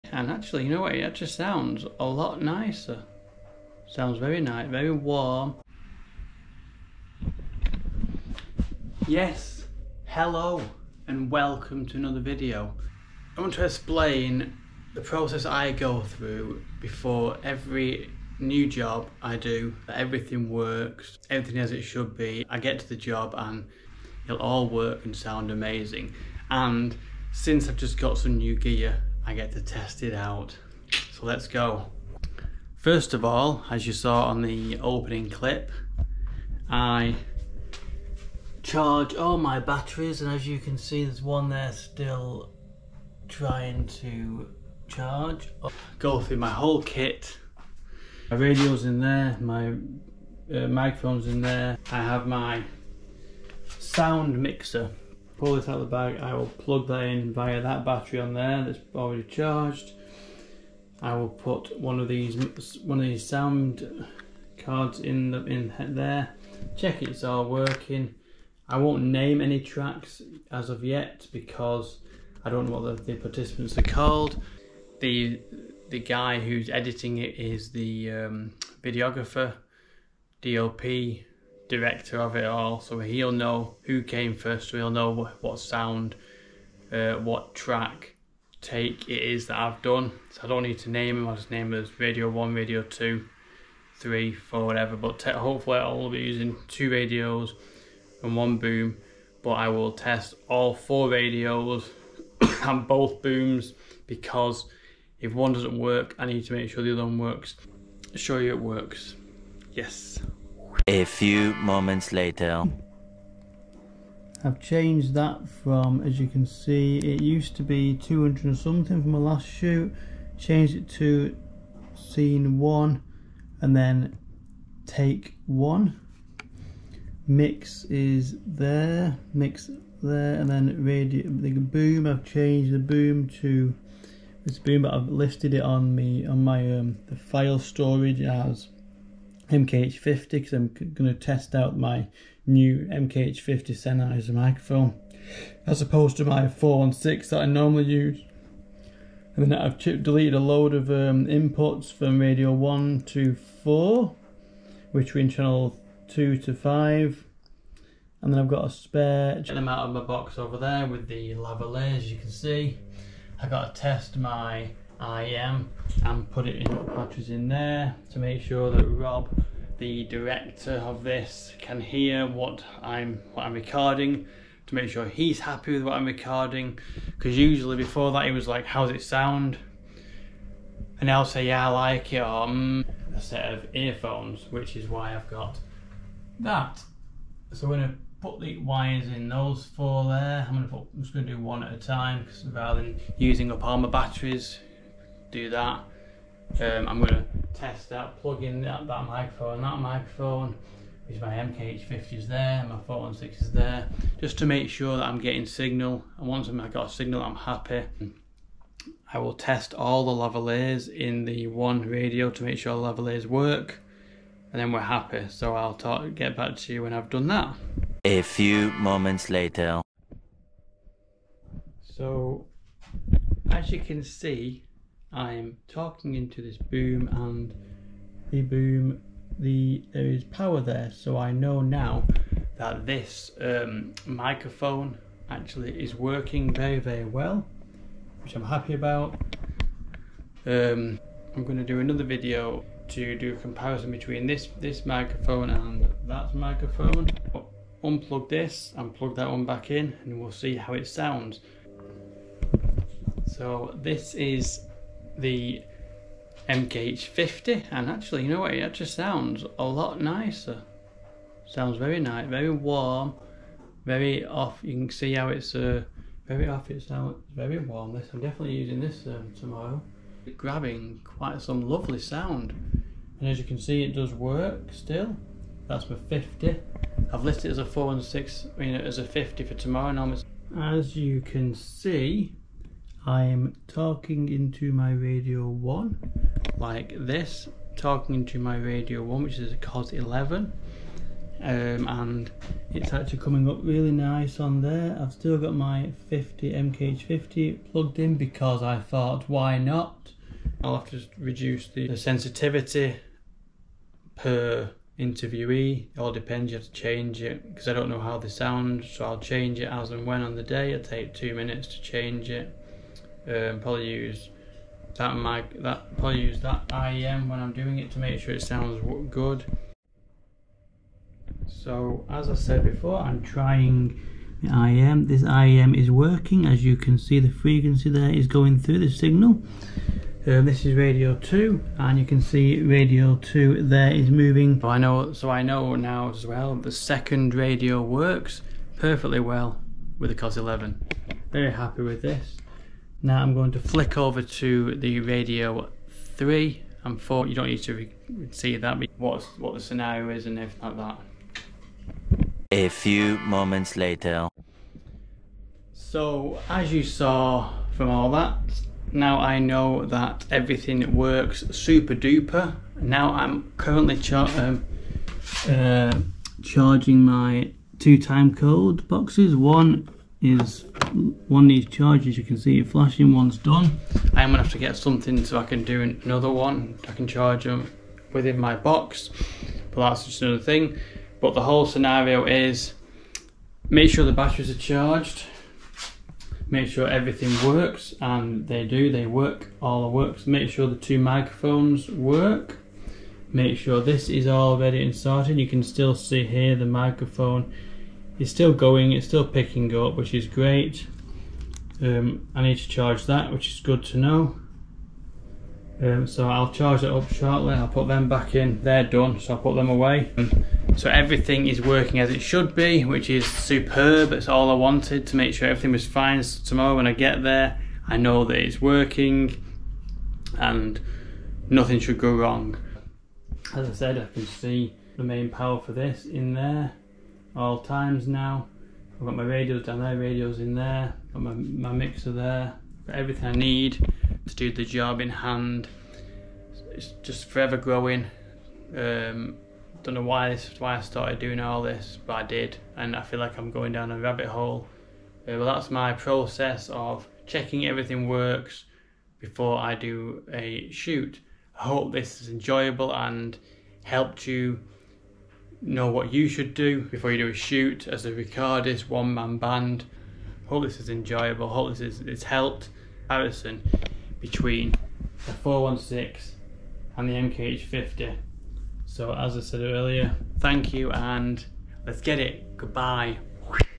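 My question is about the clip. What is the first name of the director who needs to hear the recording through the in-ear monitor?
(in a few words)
Rob.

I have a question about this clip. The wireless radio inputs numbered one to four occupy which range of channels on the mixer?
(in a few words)
channel 2 to 5.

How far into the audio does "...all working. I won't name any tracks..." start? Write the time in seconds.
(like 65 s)
67 s.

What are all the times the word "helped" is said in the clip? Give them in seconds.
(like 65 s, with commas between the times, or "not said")
453 s, 462 s.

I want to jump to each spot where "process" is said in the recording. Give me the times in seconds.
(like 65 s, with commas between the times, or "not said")
15 s, 445 s.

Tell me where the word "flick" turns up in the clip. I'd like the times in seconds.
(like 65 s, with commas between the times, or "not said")
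343 s.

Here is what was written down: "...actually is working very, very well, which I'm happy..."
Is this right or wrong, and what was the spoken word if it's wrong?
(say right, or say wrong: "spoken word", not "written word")
right.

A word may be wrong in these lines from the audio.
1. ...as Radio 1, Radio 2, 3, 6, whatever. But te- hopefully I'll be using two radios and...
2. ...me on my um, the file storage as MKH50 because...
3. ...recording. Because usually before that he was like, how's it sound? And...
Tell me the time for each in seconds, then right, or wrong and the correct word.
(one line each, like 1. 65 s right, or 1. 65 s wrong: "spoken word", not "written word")
1. 91 s wrong: "4", not "6"
2. 135 s right
3. 176 s right.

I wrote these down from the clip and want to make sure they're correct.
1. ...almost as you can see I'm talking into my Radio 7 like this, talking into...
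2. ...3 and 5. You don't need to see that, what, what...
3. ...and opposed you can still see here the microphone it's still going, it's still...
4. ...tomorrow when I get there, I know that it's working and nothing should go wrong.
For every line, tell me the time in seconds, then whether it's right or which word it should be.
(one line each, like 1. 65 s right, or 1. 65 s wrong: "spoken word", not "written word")
1. 279 s wrong: "1", not "7"
2. 346 s wrong: "4", not "5"
3. 394 s wrong: "started", not "opposed"
4. 416 s right.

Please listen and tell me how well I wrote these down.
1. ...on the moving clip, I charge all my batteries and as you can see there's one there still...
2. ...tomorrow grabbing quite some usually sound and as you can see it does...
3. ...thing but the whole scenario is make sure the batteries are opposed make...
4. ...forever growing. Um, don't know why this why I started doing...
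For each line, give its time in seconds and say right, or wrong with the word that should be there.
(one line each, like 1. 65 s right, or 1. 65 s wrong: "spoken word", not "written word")
1. 34 s wrong: "opening", not "moving"
2. 269 s wrong: "lovely", not "usually"
3. 380 s wrong: "charged", not "opposed"
4. 437 s right.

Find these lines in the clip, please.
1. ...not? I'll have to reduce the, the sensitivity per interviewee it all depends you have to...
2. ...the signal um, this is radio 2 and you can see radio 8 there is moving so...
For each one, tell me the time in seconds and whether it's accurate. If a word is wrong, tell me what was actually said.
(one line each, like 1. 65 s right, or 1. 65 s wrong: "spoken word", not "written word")
1. 299 s right
2. 328 s wrong: "2", not "8".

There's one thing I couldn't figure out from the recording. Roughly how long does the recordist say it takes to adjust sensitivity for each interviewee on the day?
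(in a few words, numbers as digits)
2 minutes.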